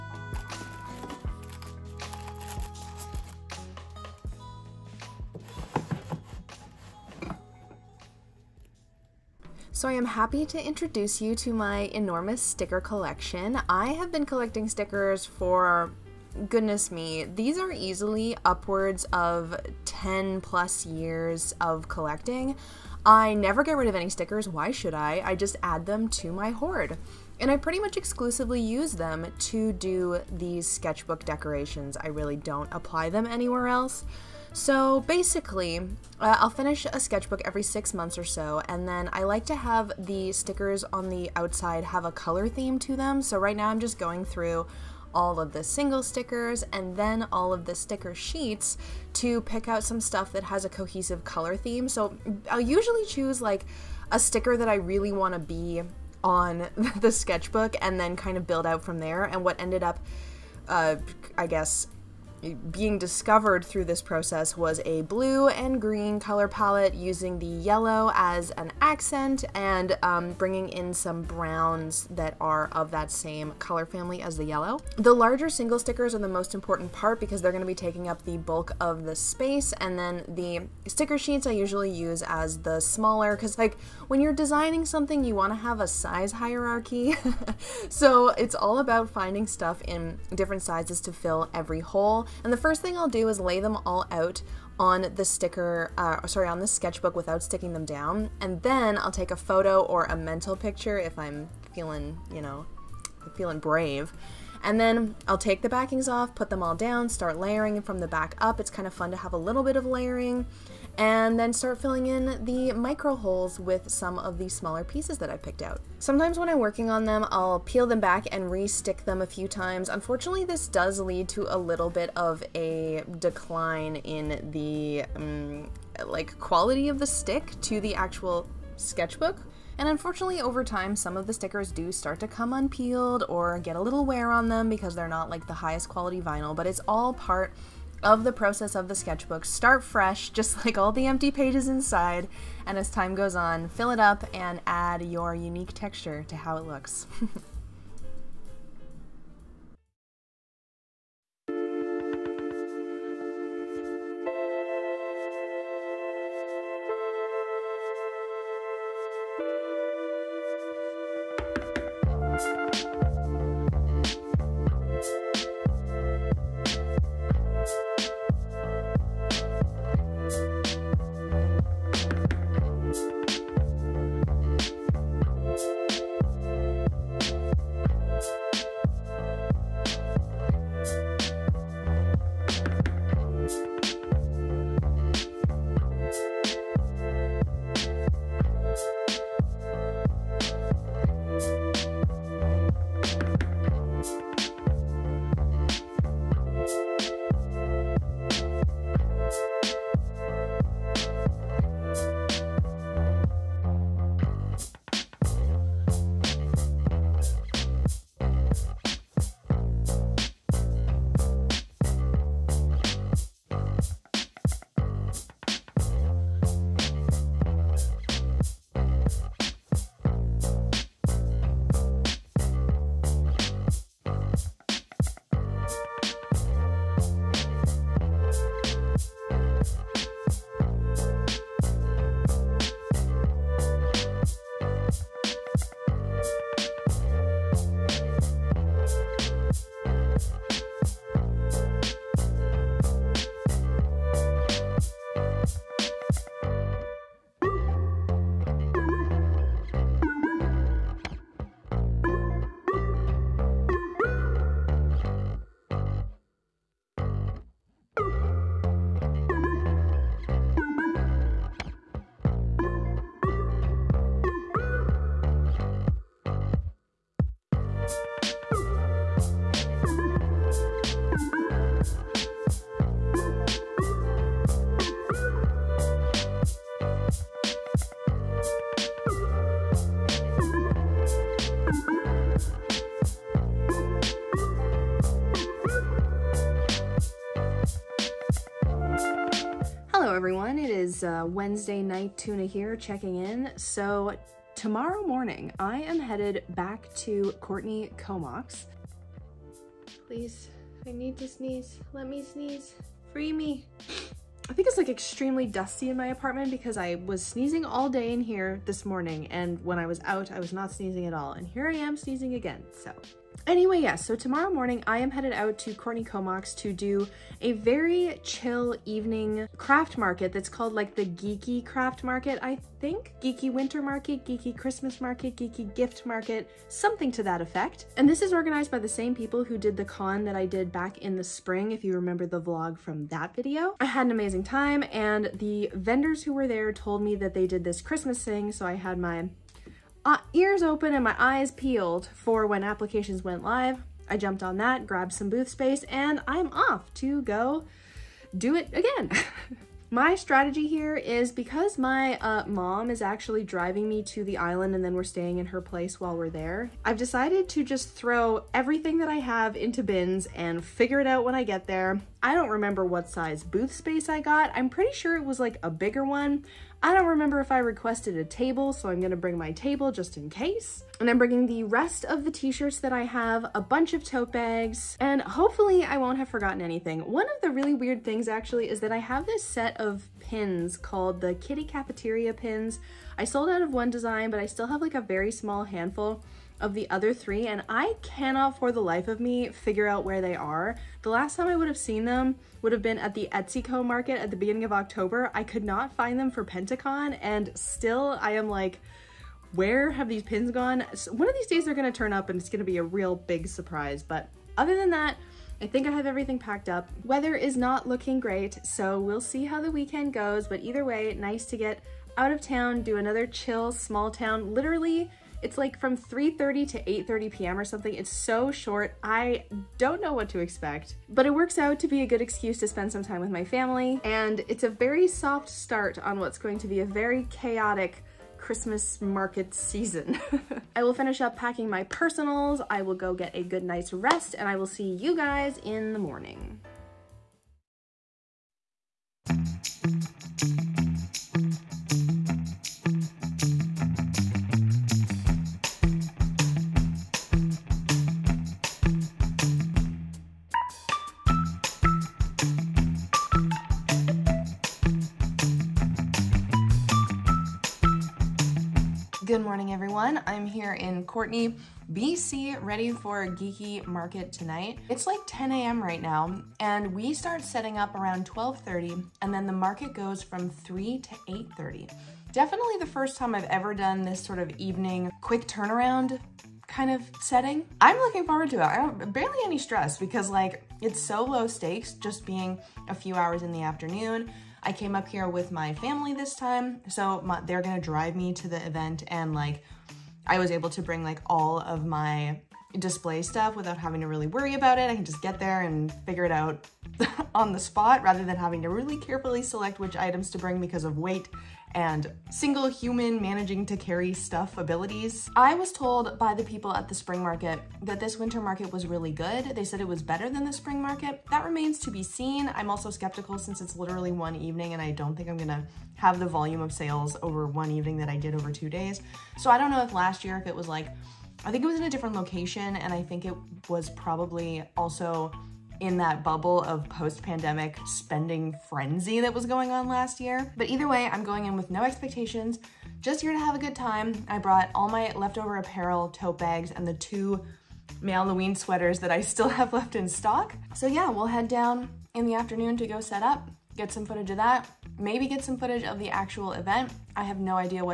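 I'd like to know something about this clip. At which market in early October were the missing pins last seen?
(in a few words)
Etsyco market.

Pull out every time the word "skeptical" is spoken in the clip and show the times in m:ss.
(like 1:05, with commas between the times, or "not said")
8:32.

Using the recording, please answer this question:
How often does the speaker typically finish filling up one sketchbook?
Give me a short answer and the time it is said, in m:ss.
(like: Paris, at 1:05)
every six months, at 0:37.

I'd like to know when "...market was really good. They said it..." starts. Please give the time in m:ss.
8:28.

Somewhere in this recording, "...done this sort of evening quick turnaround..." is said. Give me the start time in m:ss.
7:53.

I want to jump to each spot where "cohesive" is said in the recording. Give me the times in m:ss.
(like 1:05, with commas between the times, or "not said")
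0:50.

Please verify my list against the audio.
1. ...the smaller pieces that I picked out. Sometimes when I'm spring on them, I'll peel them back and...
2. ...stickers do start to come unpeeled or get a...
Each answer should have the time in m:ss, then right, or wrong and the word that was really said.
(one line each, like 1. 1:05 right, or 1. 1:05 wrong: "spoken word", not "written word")
1. 1:54 wrong: "working", not "spring"
2. 2:11 right.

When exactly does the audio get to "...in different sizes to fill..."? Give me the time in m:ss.
1:29.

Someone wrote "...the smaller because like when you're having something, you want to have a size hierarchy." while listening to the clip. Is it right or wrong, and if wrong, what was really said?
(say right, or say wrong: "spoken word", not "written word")
wrong: "designing", not "having".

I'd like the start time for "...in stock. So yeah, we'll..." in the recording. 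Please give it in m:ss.
8:59.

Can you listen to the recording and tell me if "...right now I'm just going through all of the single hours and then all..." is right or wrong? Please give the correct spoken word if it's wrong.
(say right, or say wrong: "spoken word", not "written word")
wrong: "stickers", not "hours".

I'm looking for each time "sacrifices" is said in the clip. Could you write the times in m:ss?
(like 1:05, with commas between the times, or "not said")
not said.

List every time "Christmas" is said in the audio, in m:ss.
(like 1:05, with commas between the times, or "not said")
5:24, 5:37, 7:08.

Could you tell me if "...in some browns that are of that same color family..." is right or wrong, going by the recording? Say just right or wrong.
right.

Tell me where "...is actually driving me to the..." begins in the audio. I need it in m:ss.
5:52.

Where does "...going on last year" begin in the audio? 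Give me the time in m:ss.
8:49.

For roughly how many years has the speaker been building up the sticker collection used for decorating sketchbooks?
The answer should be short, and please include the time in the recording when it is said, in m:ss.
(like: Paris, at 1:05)
10 plus years, at 0:19.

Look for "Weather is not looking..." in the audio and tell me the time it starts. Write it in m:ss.
6:47.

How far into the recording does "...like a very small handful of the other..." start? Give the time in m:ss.
6:24.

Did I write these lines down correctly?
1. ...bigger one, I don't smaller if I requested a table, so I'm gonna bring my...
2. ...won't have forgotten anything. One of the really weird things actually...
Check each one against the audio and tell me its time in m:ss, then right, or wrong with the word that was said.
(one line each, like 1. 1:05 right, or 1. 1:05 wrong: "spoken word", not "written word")
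1. 6:05 wrong: "remember", not "smaller"
2. 6:15 right.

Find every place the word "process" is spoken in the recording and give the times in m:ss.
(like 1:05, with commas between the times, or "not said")
1:04, 2:18.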